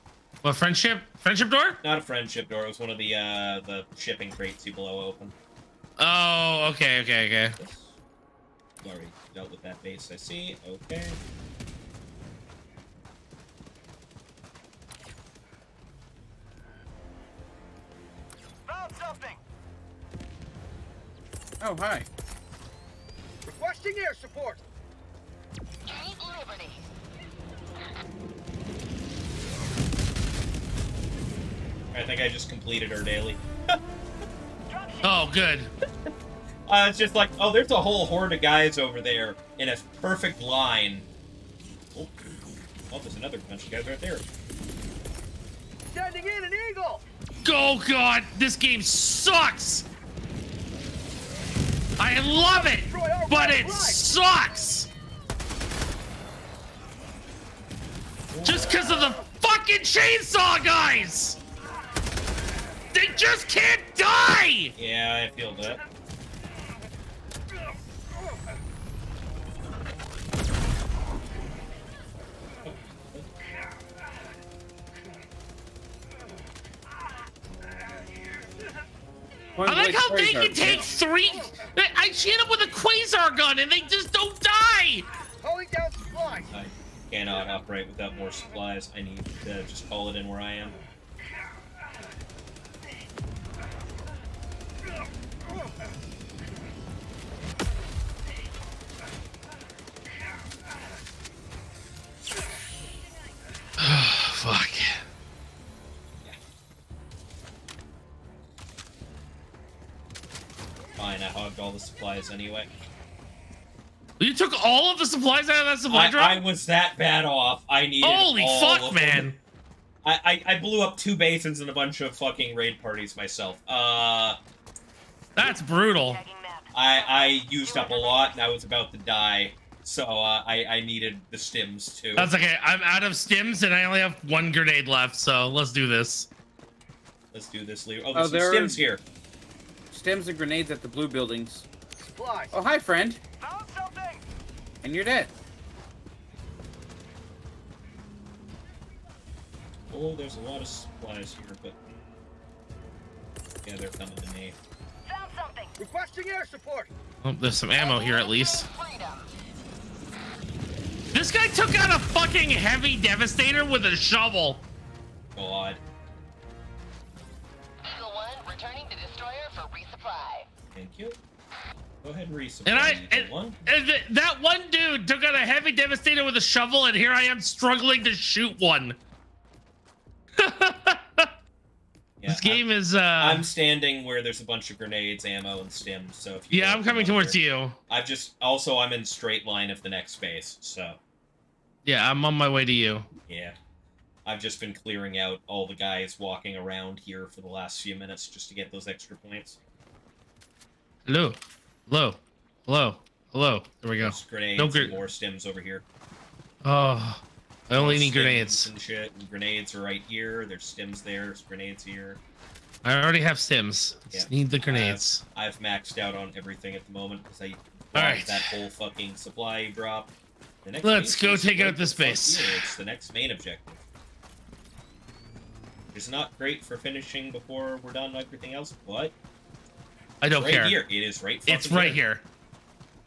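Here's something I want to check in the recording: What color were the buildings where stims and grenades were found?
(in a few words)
Blue.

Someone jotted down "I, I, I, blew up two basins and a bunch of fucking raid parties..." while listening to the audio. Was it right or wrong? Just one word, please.
right.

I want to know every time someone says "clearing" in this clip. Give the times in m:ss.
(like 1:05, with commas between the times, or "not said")
3:14.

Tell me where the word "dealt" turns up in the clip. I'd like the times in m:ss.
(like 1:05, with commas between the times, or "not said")
0:09.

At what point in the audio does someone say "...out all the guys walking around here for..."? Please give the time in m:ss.
3:15.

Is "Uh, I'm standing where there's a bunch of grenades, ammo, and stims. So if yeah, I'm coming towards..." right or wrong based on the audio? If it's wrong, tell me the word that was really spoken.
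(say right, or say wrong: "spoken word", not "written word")
right.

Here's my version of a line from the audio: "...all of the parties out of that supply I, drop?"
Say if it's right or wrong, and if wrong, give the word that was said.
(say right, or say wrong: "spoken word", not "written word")
wrong: "supplies", not "parties".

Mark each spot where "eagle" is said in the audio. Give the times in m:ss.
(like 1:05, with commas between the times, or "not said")
0:46, 2:47.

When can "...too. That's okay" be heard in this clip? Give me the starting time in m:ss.
2:12.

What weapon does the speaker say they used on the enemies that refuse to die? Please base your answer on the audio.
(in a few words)
Quasar gun.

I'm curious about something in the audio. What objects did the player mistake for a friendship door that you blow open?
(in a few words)
Shipping crates.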